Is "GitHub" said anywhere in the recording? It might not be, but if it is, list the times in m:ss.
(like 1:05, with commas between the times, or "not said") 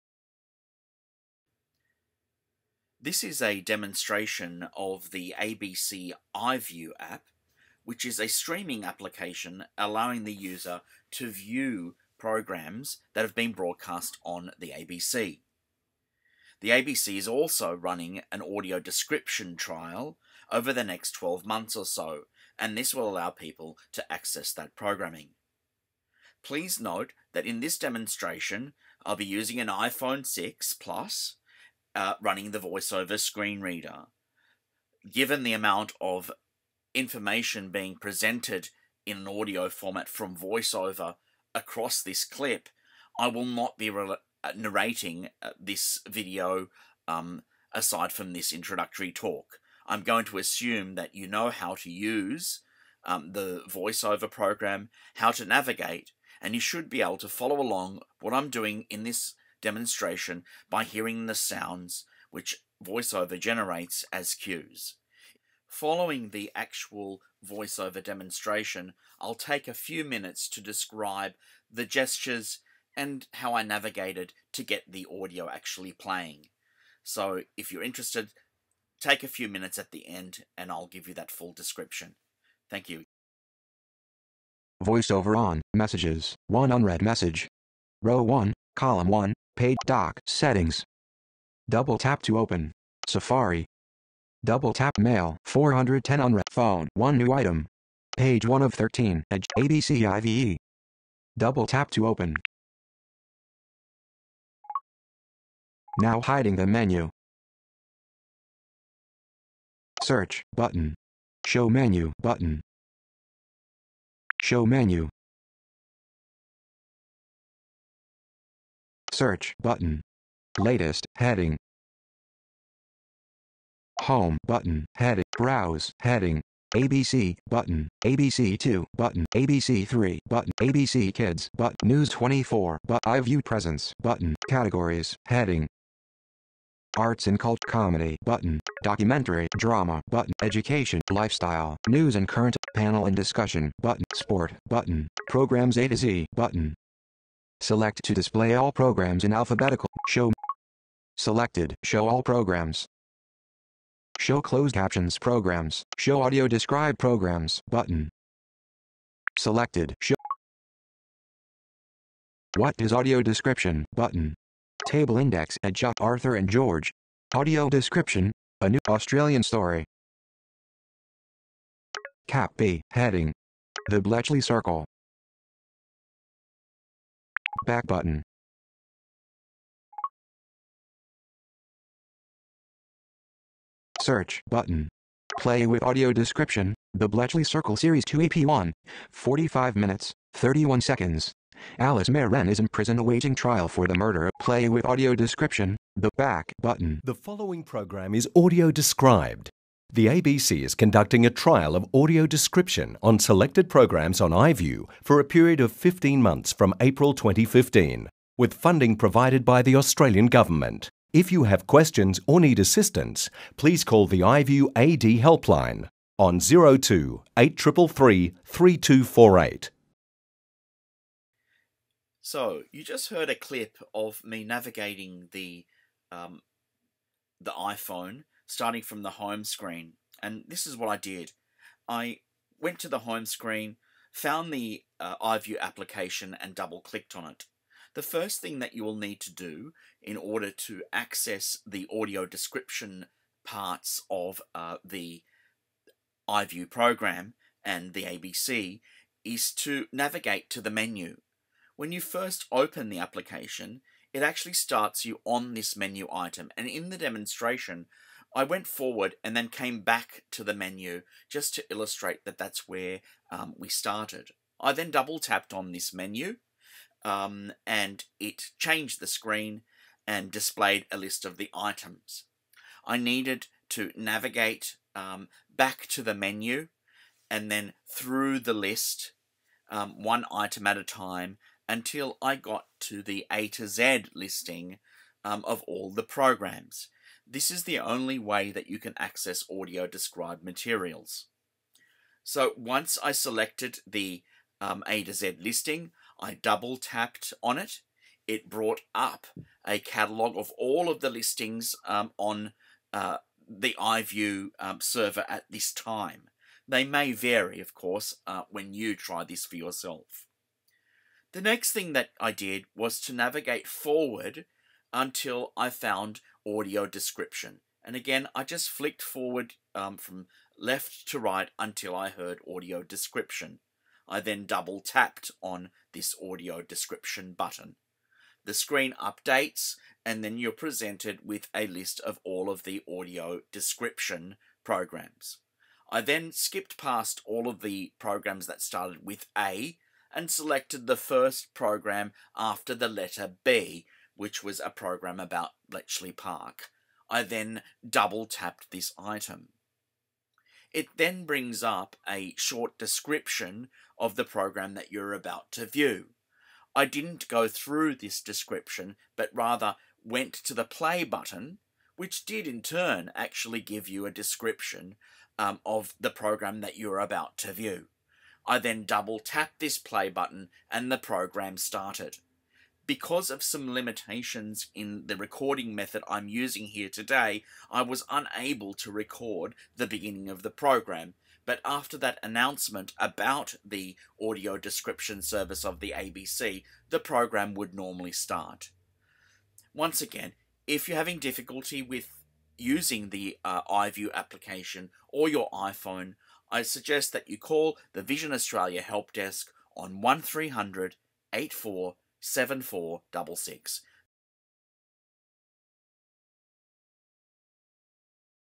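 not said.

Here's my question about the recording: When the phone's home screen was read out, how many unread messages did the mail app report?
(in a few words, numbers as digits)
410.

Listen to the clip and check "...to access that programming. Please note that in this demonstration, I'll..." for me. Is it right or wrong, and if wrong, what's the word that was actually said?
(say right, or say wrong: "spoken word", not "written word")
right.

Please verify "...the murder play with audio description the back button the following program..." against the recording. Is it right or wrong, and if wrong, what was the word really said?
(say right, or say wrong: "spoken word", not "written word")
right.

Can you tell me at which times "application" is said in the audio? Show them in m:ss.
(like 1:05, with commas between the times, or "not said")
0:08, 3:55, 4:12, 6:34.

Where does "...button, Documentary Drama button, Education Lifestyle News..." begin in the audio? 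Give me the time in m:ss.
2:18.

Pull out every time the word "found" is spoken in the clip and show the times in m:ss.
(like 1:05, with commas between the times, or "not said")
3:54, 5:15.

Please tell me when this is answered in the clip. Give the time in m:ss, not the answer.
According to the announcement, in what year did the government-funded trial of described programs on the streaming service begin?
3:27.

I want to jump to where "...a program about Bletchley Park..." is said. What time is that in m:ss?
5:44.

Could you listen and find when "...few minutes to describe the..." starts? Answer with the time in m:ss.
1:09.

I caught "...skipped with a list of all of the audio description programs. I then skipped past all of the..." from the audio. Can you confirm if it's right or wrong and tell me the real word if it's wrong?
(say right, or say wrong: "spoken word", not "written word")
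wrong: "presented", not "skipped".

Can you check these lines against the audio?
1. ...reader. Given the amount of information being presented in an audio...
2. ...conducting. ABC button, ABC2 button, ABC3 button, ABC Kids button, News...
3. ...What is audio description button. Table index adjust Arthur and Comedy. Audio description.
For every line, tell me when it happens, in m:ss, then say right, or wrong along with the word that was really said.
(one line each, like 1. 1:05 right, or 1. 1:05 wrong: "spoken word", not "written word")
1. 0:33 right
2. 2:06 wrong: "heading", not "conducting"
3. 2:42 wrong: "George", not "Comedy".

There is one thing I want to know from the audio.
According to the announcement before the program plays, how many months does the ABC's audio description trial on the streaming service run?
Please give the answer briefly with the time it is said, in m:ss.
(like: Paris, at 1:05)
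15 months, at 3:25.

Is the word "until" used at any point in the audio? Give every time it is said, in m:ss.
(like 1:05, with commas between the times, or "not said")
4:41, 5:14, 5:21.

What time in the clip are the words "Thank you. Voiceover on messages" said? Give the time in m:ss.
1:22.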